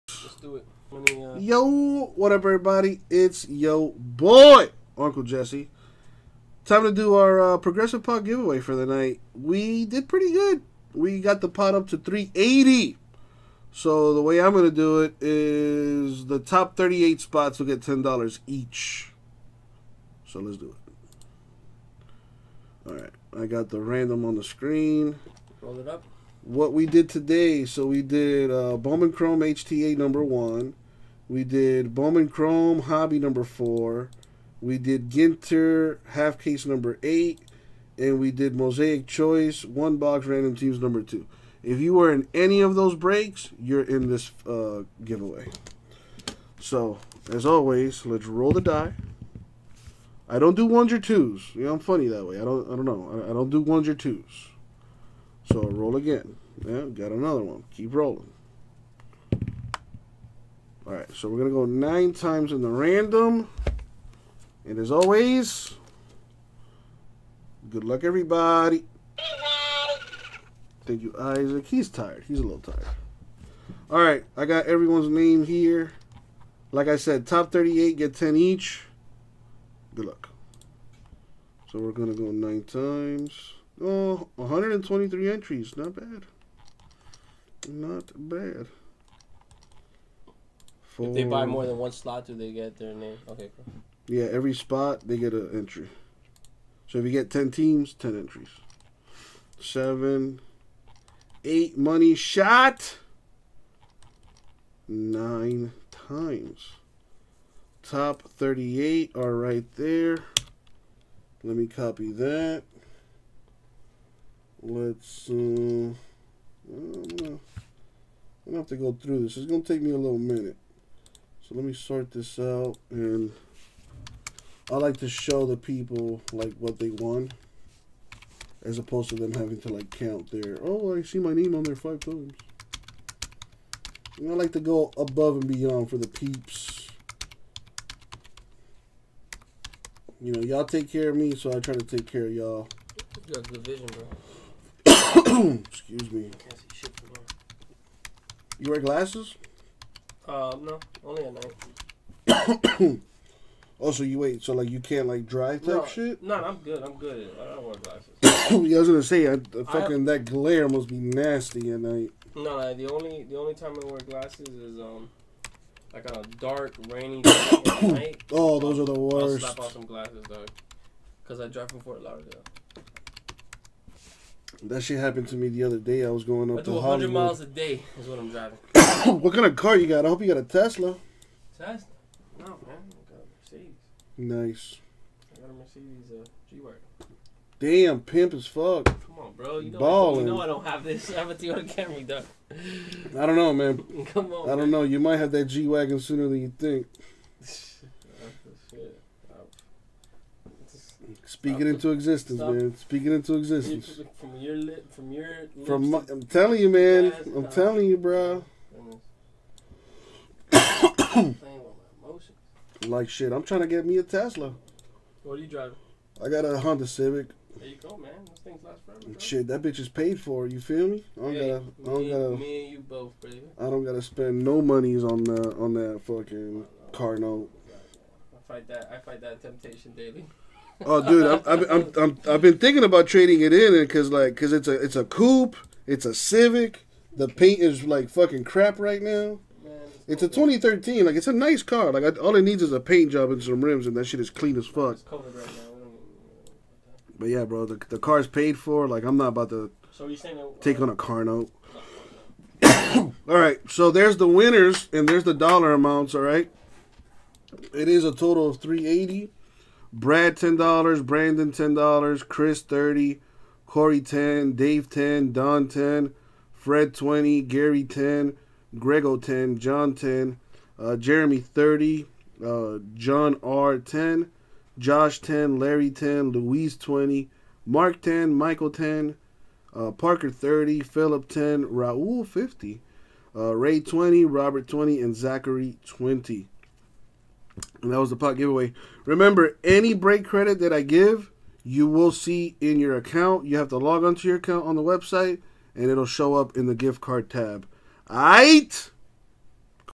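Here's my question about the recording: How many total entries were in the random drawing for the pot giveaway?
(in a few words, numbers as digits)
123.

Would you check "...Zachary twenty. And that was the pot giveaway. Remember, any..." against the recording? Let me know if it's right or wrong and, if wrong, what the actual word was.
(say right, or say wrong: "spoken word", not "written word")
right.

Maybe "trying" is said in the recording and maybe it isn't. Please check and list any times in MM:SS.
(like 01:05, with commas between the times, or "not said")
03:33.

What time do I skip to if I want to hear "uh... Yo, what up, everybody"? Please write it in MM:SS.
00:00.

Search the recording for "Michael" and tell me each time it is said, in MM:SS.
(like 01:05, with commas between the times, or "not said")
04:38.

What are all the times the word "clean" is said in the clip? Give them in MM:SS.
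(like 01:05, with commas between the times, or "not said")
04:04.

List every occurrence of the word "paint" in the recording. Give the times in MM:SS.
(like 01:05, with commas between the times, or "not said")
03:57, 04:02.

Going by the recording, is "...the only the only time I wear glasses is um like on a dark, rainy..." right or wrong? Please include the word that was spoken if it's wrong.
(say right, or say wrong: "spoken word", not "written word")
right.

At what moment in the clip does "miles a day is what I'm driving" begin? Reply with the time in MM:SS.
02:57.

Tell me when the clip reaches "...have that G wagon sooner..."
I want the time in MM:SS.
03:15.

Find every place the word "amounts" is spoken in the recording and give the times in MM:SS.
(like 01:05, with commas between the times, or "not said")
04:15.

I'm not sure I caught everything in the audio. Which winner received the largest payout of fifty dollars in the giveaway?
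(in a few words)
Raul.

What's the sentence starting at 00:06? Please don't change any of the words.
Time to do our uh, progressive pot giveaway for the night.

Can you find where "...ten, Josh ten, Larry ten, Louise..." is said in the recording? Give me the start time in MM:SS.
04:33.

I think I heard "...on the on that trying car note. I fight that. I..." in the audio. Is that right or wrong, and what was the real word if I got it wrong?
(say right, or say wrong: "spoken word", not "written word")
wrong: "fucking", not "trying".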